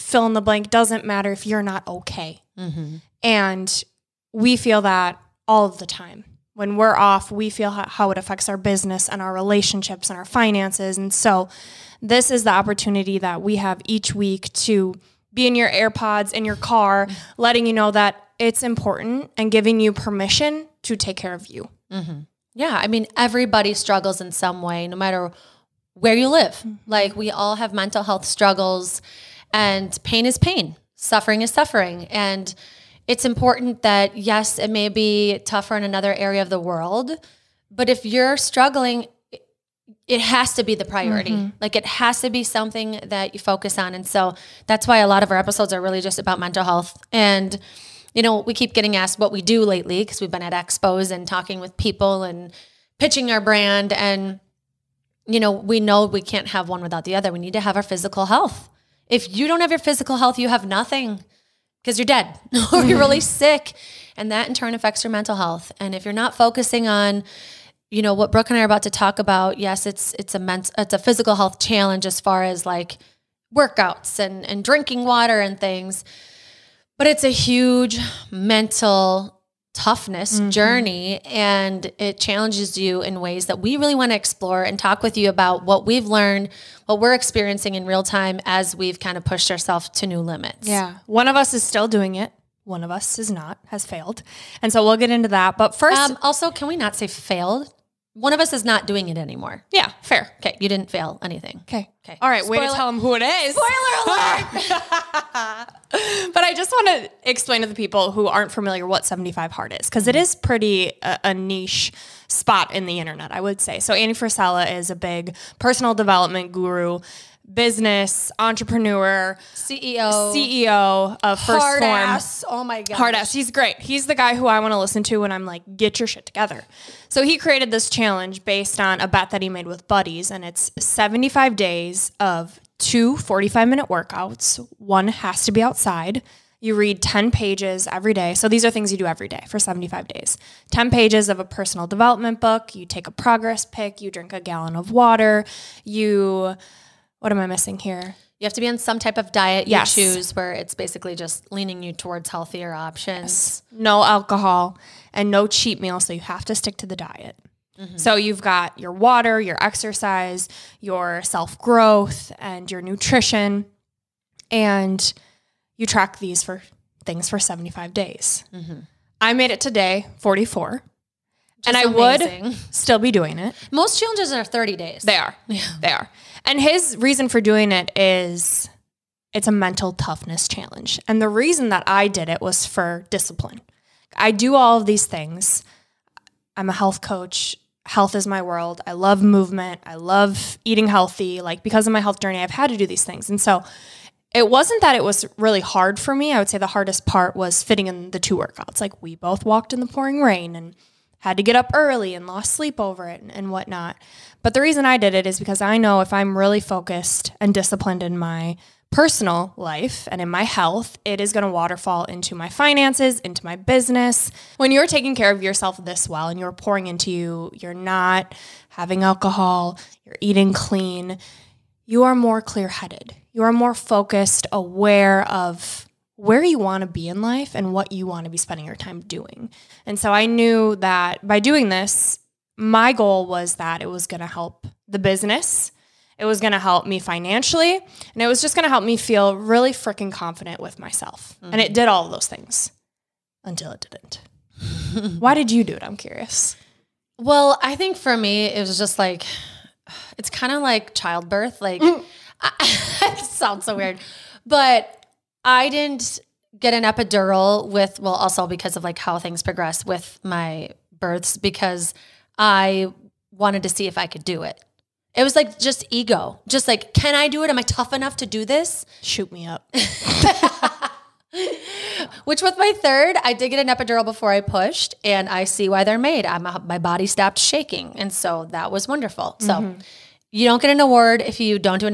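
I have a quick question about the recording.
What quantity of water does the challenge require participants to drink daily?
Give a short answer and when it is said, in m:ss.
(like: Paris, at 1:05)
a gallon, at 2:24.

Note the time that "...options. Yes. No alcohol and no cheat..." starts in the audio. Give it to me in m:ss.
2:32.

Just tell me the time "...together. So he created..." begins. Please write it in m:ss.
2:06.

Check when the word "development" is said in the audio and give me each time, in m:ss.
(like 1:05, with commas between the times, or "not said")
1:55, 2:21.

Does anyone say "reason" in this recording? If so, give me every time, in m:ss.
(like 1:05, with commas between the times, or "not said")
2:56, 3:01, 3:24.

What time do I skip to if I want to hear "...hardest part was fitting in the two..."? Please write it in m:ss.
3:16.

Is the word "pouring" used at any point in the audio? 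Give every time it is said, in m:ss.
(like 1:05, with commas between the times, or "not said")
3:19, 3:36.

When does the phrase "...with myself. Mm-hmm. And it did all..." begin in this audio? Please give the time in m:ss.
4:00.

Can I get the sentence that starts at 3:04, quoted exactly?
I do all of these things.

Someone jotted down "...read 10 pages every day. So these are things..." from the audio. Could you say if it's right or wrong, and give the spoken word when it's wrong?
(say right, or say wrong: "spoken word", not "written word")
right.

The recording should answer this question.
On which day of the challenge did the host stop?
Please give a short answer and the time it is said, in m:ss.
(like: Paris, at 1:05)
44, at 2:50.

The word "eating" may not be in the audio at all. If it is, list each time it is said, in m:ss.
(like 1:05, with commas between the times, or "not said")
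3:10, 3:40.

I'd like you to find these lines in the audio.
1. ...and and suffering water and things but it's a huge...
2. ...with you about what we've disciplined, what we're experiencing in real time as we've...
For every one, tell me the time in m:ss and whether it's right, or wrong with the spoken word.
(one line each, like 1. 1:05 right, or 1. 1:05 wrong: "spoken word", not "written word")
1. 1:14 wrong: "drinking", not "suffering"
2. 1:25 wrong: "learned", not "disciplined".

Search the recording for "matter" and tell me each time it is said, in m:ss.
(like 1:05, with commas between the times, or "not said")
0:01, 0:24.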